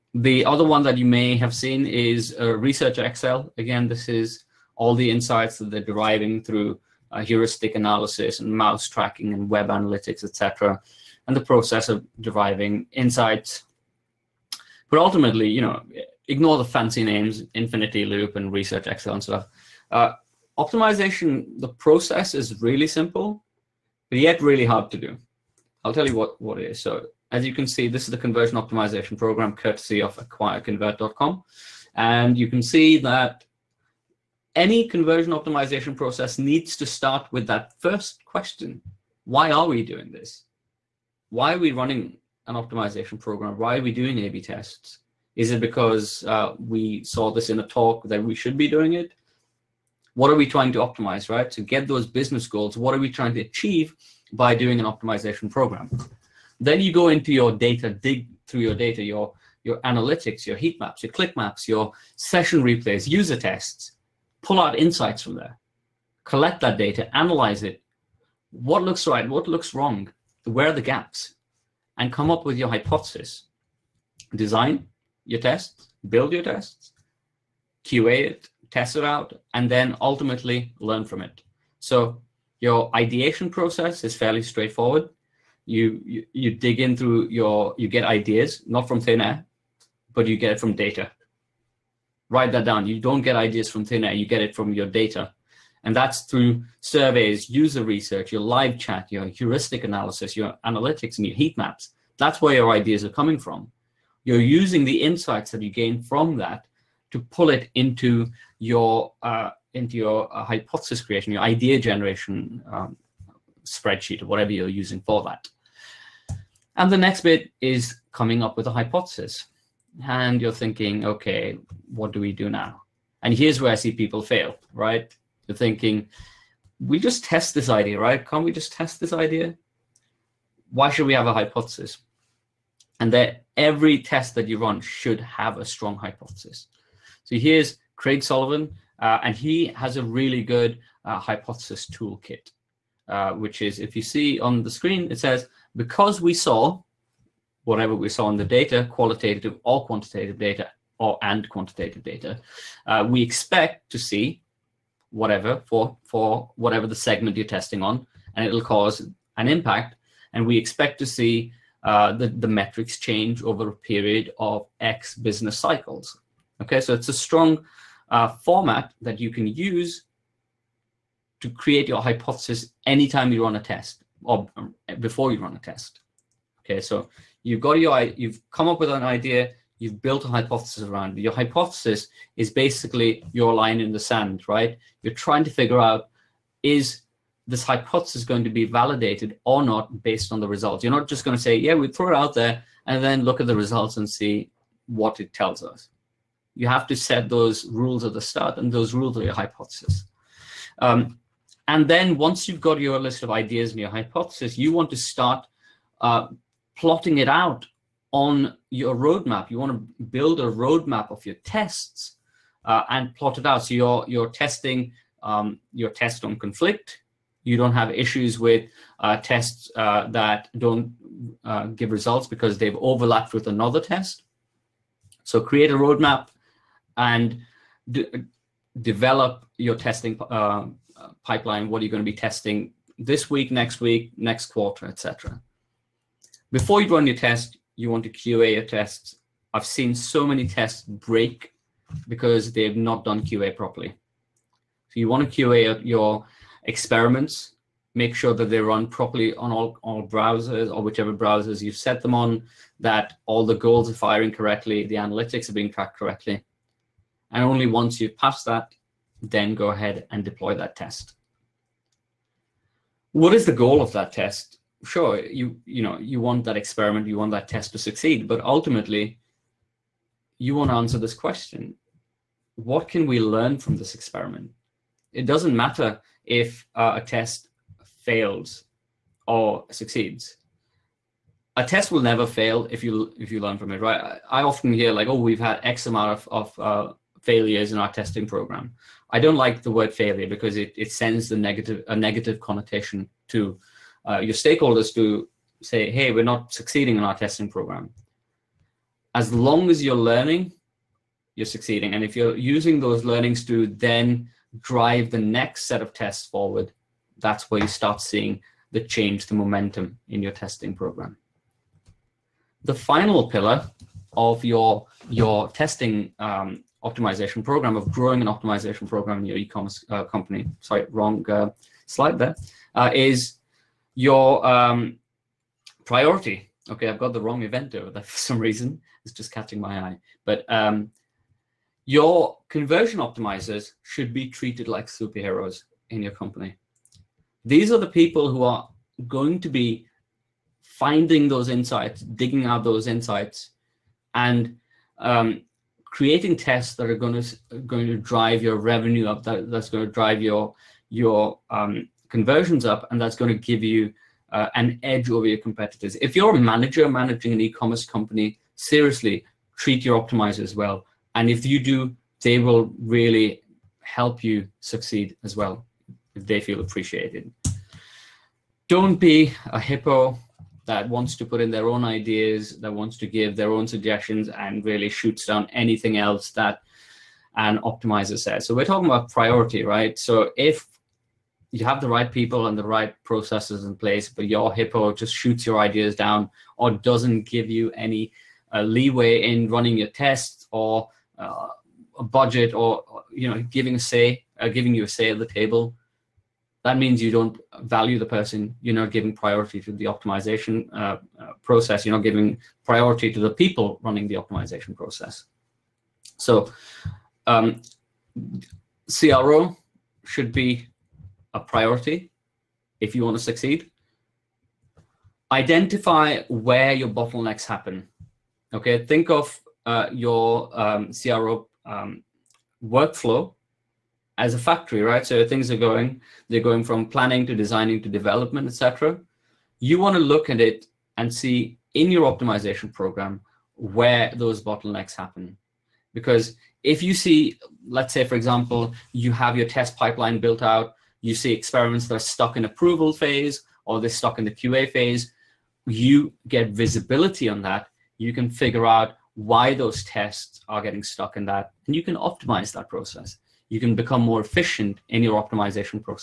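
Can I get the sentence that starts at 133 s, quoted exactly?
And that every test that you run should have a strong hypothesis.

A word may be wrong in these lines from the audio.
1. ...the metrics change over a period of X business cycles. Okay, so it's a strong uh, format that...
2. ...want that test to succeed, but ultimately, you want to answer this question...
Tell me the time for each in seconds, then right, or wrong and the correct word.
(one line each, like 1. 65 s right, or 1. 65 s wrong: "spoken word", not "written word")
1. 162 s right
2. 267 s right.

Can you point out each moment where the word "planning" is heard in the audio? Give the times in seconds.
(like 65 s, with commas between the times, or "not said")
426 s.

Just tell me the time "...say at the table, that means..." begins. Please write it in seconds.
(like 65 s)
394 s.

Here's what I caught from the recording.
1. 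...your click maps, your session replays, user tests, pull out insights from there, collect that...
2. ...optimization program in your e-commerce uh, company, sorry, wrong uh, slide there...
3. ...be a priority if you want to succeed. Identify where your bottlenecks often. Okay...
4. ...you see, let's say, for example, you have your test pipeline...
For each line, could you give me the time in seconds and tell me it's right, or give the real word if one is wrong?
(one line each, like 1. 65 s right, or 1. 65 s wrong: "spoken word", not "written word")
1. 61 s right
2. 318 s right
3. 410 s wrong: "happen", not "often"
4. 436 s right.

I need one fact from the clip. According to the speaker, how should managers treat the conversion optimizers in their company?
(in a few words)
like superheroes.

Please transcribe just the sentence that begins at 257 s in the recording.
And only once you've passed that, then go ahead and deploy that test.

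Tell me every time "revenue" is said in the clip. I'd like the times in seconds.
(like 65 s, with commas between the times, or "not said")
348 s.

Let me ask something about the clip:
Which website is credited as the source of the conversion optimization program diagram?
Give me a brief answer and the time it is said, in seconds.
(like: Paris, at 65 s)
acquireconvert.com, at 30 s.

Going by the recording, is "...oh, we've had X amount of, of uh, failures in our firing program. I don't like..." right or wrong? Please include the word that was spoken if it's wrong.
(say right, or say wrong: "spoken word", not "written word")
wrong: "testing", not "firing".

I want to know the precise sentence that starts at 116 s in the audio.
And the next bit is coming up with a hypothesis.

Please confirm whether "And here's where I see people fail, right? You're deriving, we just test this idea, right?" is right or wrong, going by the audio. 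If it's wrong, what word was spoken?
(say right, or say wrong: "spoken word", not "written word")
wrong: "thinking", not "deriving".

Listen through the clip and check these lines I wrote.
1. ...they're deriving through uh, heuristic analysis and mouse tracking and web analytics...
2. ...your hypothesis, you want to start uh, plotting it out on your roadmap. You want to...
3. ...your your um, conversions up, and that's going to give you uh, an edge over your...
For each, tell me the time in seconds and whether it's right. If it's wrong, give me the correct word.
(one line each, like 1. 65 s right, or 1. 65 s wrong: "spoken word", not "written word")
1. 5 s right
2. 203 s right
3. 350 s right.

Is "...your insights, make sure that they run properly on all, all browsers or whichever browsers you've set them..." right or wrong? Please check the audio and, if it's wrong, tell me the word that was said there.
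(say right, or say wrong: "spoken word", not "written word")
wrong: "experiments", not "insights".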